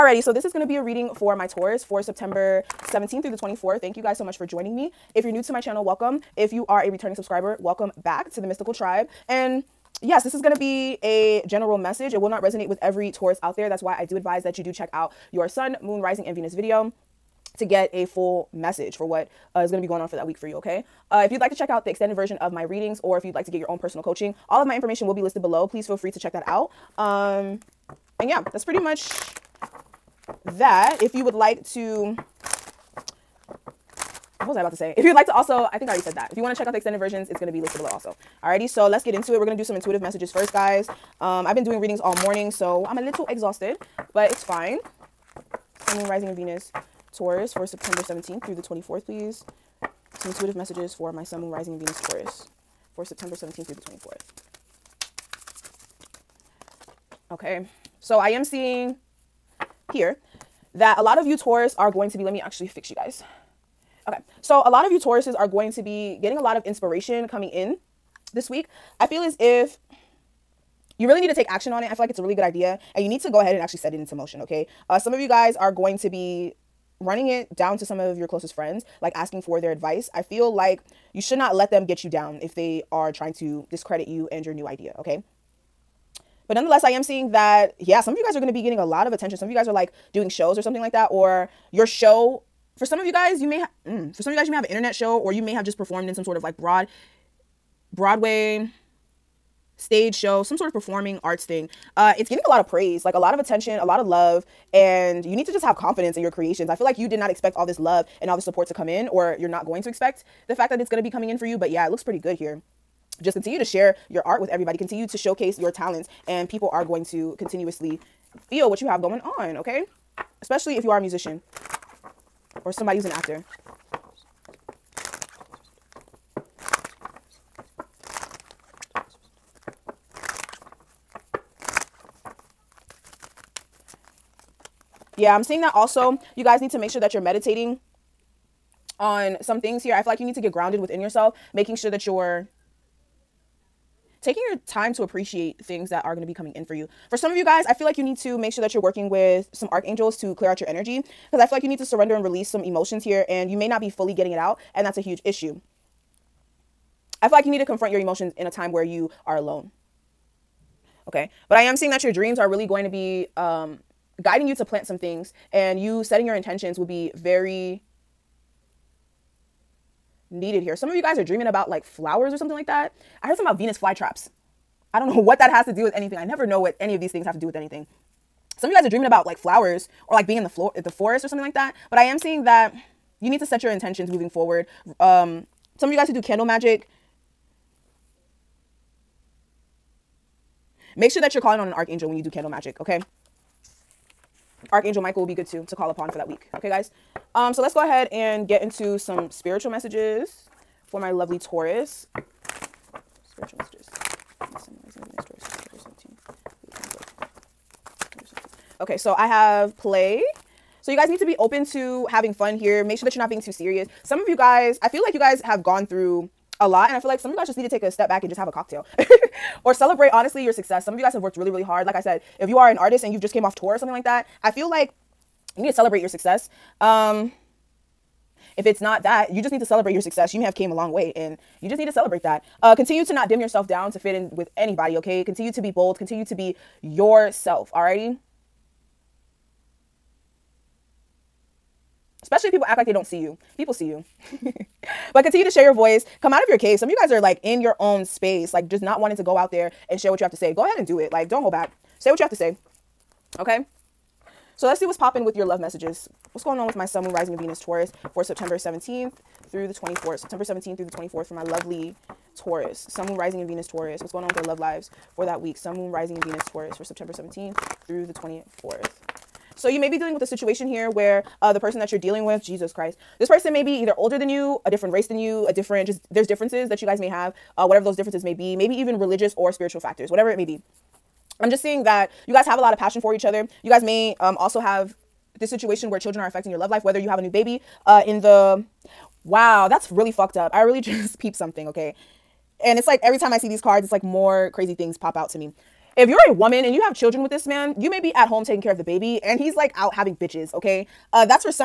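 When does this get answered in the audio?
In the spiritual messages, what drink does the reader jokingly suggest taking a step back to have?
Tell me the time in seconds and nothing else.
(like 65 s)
218 s.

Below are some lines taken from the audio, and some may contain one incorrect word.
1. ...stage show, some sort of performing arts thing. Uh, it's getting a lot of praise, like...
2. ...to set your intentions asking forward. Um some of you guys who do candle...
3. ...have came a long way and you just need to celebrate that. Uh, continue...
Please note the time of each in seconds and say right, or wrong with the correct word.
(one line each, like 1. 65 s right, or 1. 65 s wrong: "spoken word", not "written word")
1. 99 s right
2. 183 s wrong: "moving", not "asking"
3. 230 s right.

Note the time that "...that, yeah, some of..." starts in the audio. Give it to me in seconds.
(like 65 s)
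87 s.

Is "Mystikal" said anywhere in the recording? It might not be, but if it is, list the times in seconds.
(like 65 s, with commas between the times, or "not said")
8 s.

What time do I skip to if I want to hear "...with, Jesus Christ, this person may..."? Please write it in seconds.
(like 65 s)
272 s.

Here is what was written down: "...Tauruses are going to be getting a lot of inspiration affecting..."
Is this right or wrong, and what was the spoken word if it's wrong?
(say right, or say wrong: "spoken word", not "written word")
wrong: "coming", not "affecting".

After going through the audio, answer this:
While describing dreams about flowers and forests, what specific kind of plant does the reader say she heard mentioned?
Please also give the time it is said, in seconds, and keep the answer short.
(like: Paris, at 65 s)
Venus flytraps, at 173 s.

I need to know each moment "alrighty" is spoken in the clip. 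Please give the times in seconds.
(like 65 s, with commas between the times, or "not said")
38 s, 237 s.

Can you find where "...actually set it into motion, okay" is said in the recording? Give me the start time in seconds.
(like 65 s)
73 s.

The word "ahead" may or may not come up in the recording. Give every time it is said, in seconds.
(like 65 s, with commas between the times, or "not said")
73 s, 197 s, 250 s.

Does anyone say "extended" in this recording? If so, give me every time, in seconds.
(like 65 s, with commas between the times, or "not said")
21 s, 36 s.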